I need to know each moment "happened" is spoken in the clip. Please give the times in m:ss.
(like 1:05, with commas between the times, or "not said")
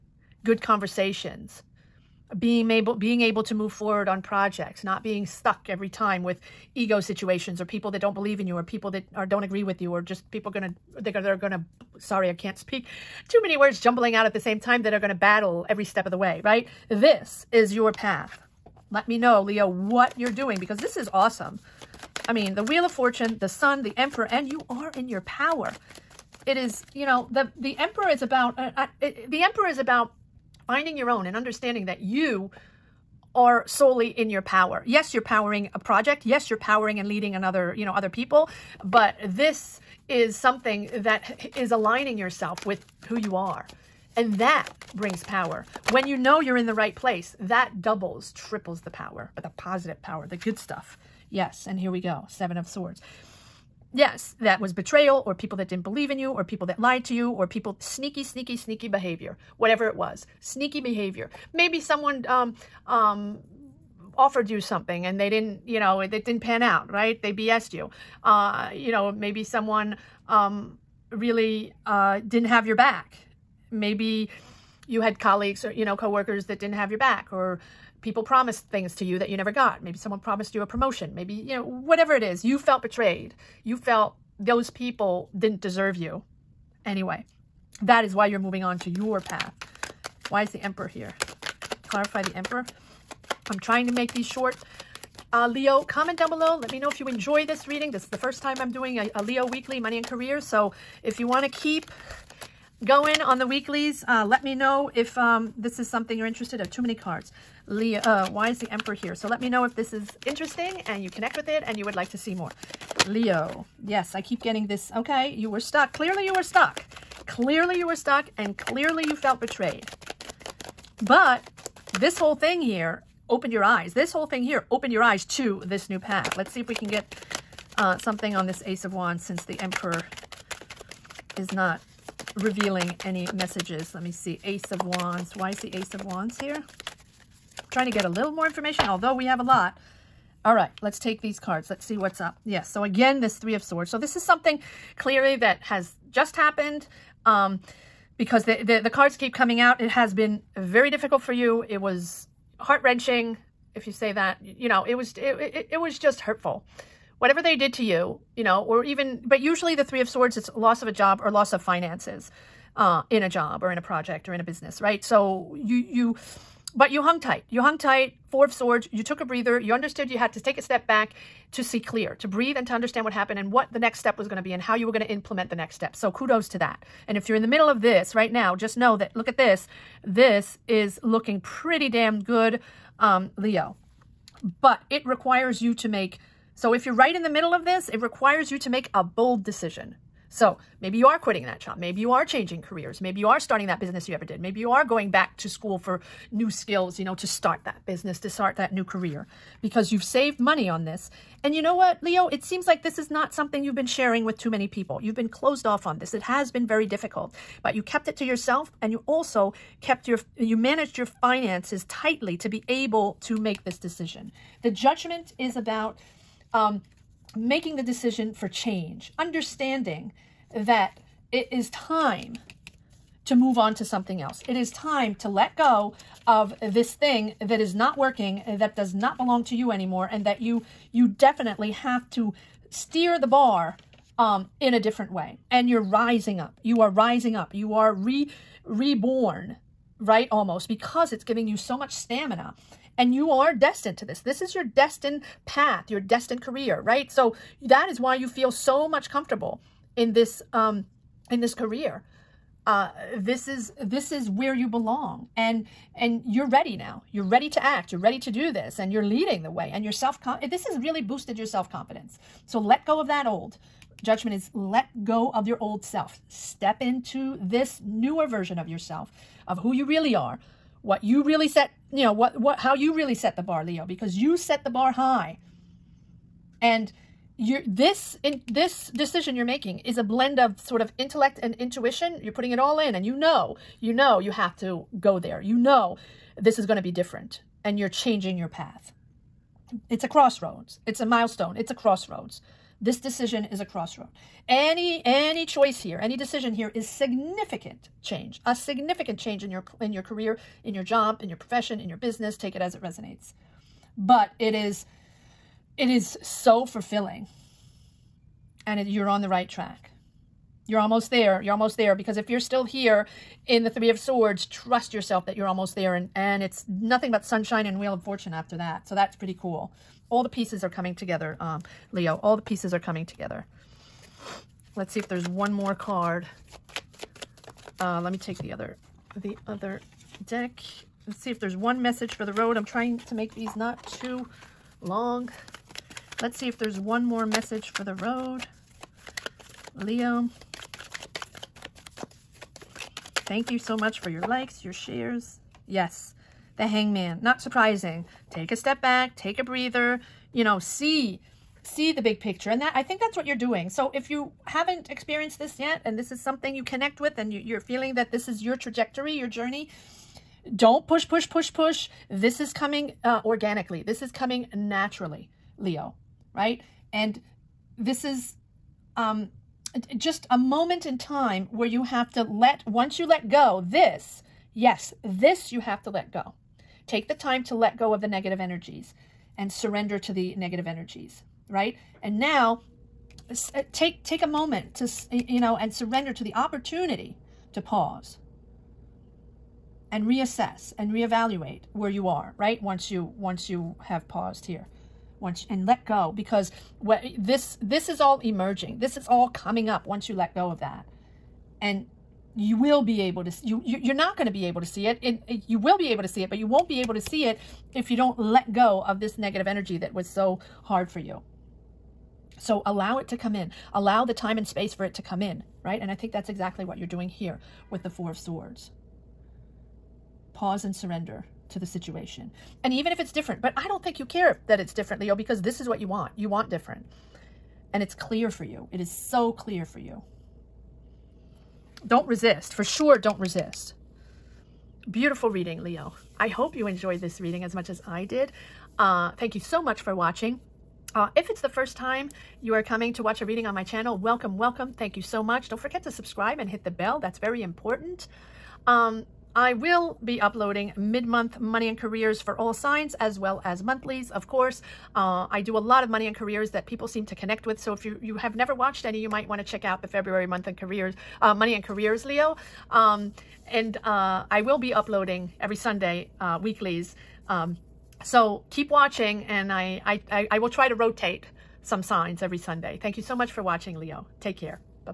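2:26, 2:53.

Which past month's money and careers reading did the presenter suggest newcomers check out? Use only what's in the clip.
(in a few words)
February.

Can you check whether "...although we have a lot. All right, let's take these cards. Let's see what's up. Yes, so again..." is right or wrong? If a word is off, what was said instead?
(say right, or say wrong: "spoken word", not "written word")
right.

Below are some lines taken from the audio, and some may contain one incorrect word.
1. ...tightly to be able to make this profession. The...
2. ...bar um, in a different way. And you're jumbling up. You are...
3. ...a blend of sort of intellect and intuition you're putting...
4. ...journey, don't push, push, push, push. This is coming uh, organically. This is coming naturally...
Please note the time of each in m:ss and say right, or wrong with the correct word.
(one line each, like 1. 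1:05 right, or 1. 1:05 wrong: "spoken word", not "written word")
1. 3:31 wrong: "decision", not "profession"
2. 3:53 wrong: "rising", not "jumbling"
3. 4:39 right
4. 5:59 right.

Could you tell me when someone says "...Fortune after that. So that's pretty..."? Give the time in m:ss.
5:18.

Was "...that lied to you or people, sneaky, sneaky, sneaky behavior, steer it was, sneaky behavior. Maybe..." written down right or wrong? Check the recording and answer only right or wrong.
wrong.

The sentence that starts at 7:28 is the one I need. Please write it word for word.
Um, I will be uploading mid-month money and careers for all signs as well as monthlies, of course.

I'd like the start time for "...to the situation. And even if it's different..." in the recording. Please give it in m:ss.
7:01.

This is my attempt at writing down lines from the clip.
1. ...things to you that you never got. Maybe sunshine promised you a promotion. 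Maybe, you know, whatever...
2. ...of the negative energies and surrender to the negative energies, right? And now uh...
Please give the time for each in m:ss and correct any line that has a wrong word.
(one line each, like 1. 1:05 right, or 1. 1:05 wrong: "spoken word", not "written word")
1. 1:18 wrong: "someone", not "sunshine"
2. 6:17 right.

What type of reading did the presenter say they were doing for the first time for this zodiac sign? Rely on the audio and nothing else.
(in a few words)
Weekly Money and Career.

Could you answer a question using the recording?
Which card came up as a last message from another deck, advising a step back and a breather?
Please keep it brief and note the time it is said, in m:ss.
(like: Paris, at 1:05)
The Hangman, at 5:46.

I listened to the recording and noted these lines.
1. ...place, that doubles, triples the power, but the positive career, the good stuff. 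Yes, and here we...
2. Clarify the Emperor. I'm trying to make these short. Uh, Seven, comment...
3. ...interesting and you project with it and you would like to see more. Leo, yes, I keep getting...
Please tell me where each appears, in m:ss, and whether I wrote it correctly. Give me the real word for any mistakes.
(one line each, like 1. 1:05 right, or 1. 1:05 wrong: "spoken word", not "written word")
1. 0:46 wrong: "power", not "career"
2. 1:31 wrong: "Leo", not "Seven"
3. 1:50 wrong: "connect", not "project".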